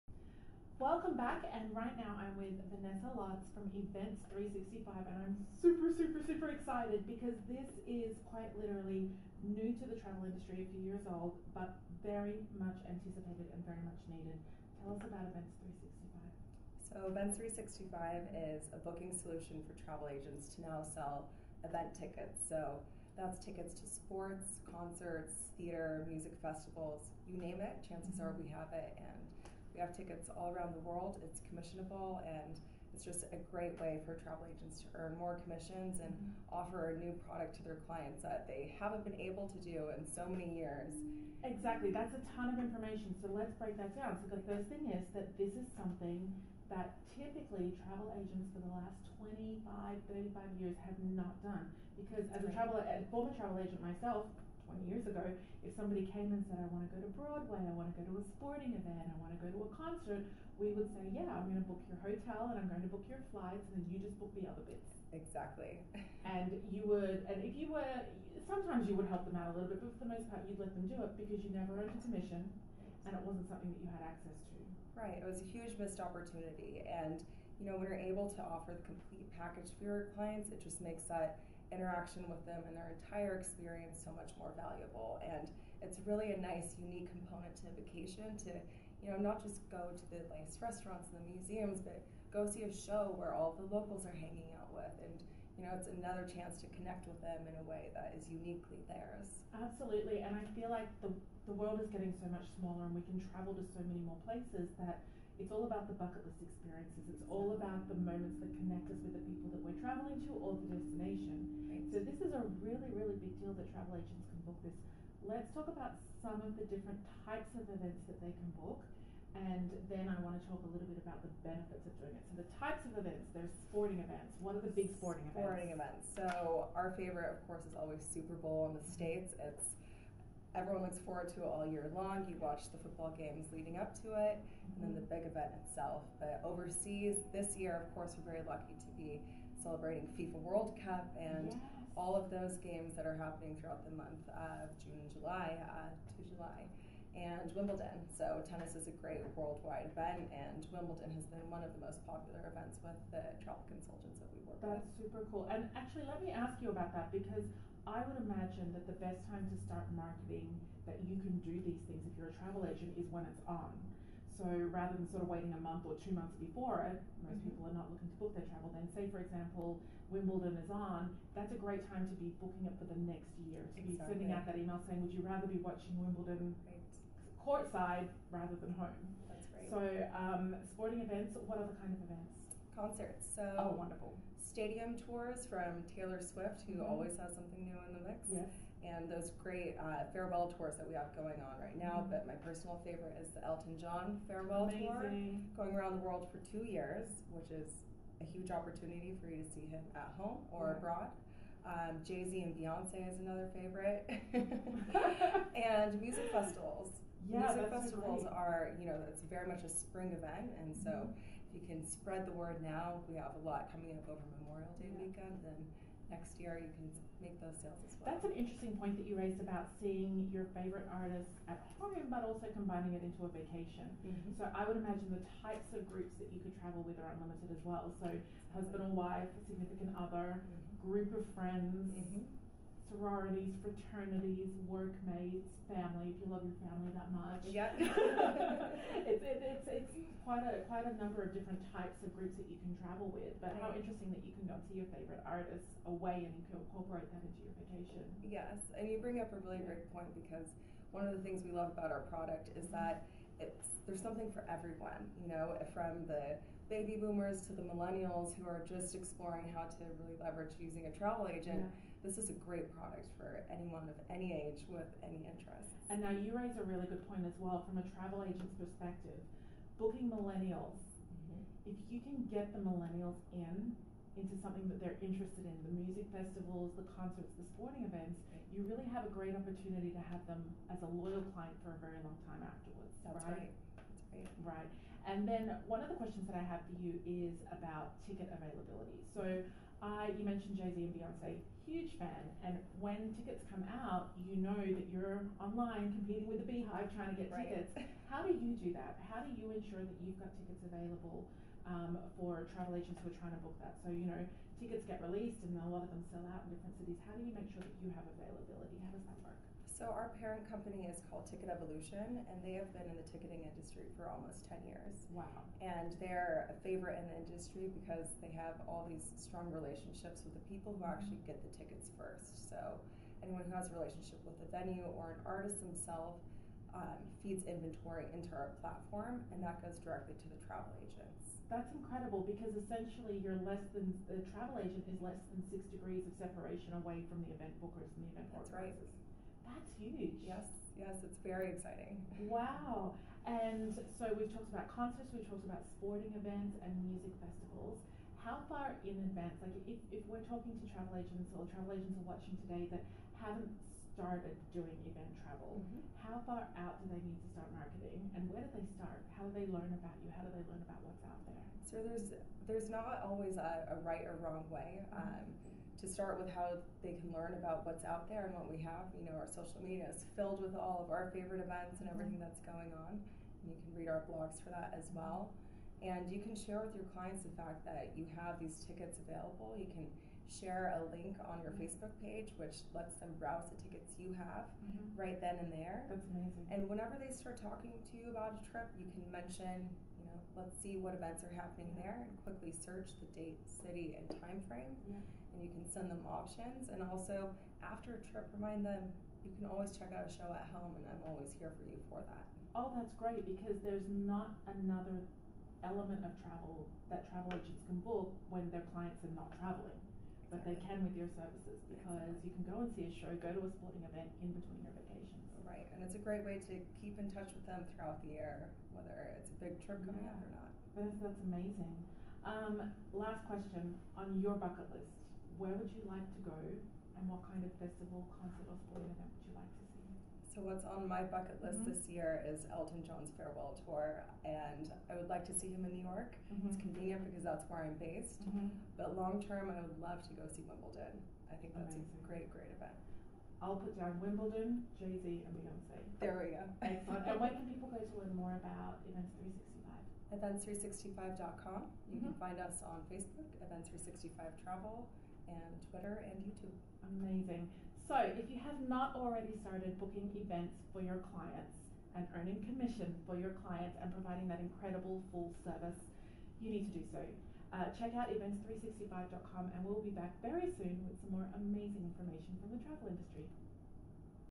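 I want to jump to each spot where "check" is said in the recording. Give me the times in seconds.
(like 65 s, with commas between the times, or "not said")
399 s, 467 s.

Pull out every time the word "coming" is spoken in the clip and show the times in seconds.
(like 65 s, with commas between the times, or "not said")
213 s, 419 s.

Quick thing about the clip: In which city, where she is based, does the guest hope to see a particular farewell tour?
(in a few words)
New York.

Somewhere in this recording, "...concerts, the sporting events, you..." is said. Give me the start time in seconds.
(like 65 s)
276 s.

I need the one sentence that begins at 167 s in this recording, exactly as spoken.
people are not looking to book their travel.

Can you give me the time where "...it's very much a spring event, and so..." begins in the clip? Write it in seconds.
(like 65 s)
209 s.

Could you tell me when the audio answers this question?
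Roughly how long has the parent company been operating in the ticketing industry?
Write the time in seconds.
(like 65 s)
314 s.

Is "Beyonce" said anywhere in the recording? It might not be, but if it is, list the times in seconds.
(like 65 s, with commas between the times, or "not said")
202 s, 290 s, 445 s.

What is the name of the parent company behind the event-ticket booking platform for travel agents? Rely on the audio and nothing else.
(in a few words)
Ticket Evolution.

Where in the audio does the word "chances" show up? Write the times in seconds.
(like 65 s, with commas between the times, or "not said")
27 s, 96 s.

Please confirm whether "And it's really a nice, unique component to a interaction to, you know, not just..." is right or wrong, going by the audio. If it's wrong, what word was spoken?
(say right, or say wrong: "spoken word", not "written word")
wrong: "vacation", not "interaction".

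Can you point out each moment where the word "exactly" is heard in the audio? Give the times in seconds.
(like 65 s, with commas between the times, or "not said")
41 s, 65 s, 173 s.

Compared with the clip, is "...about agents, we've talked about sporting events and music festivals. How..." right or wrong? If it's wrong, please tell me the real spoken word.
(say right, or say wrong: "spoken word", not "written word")
wrong: "concerts", not "agents".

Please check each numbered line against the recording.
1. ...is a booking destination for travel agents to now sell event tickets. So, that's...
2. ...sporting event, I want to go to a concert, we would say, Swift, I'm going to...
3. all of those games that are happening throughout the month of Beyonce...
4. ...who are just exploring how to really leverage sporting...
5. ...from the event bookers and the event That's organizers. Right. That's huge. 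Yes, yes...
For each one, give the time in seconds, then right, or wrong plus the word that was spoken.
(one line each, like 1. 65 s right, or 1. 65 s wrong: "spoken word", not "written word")
1. 18 s wrong: "solution", not "destination"
2. 58 s wrong: "Yeah", not "Swift"
3. 141 s wrong: "June", not "Beyonce"
4. 258 s wrong: "using", not "sporting"
5. 337 s right.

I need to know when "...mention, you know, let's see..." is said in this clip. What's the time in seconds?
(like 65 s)
389 s.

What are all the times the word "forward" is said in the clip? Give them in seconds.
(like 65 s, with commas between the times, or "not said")
131 s.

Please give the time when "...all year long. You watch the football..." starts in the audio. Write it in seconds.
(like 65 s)
131 s.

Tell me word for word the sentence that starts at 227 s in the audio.
So husband or wife, significant other, mm-hmm.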